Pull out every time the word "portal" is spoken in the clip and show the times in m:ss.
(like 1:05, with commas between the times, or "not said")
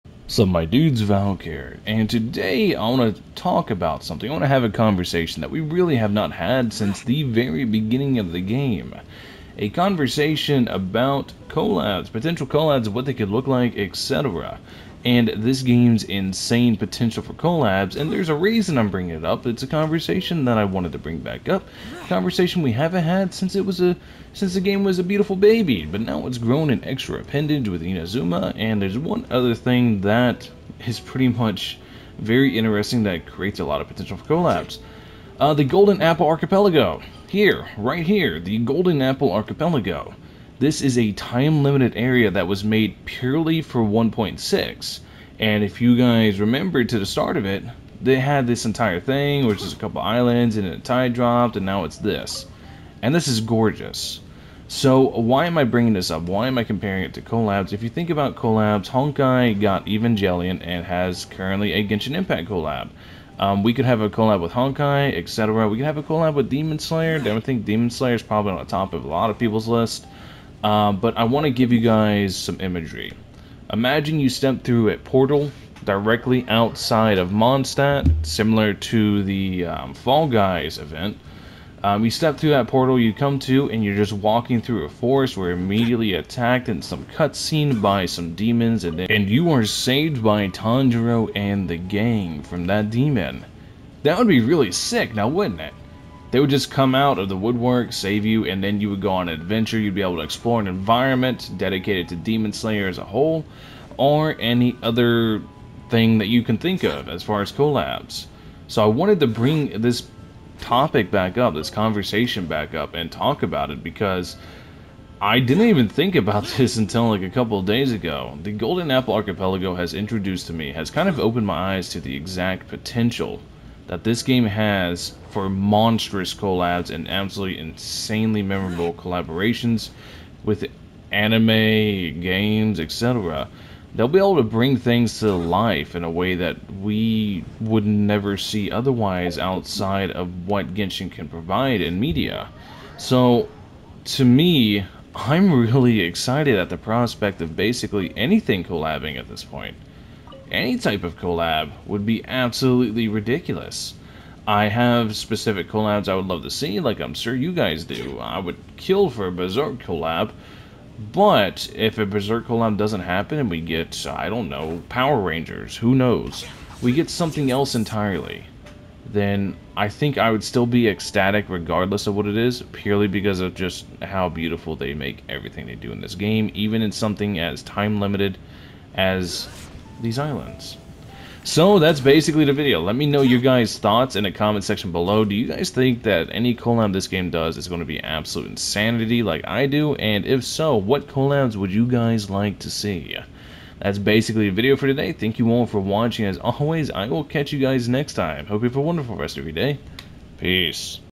1:14, 1:22.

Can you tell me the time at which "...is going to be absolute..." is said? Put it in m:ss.
3:07.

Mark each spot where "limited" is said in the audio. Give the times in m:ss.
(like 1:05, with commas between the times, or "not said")
0:41, 2:58.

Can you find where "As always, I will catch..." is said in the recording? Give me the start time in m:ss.
3:16.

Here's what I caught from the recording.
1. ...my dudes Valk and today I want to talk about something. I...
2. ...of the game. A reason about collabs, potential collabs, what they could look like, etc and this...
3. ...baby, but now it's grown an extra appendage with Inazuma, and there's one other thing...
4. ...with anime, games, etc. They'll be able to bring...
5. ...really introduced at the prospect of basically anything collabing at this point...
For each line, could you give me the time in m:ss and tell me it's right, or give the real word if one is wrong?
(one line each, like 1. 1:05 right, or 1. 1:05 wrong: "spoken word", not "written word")
1. 0:00 right
2. 0:08 wrong: "conversation", not "reason"
3. 0:25 right
4. 2:10 right
5. 2:25 wrong: "excited", not "introduced".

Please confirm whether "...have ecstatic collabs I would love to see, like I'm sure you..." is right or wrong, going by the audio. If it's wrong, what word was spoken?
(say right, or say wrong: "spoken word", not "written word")
wrong: "specific", not "ecstatic".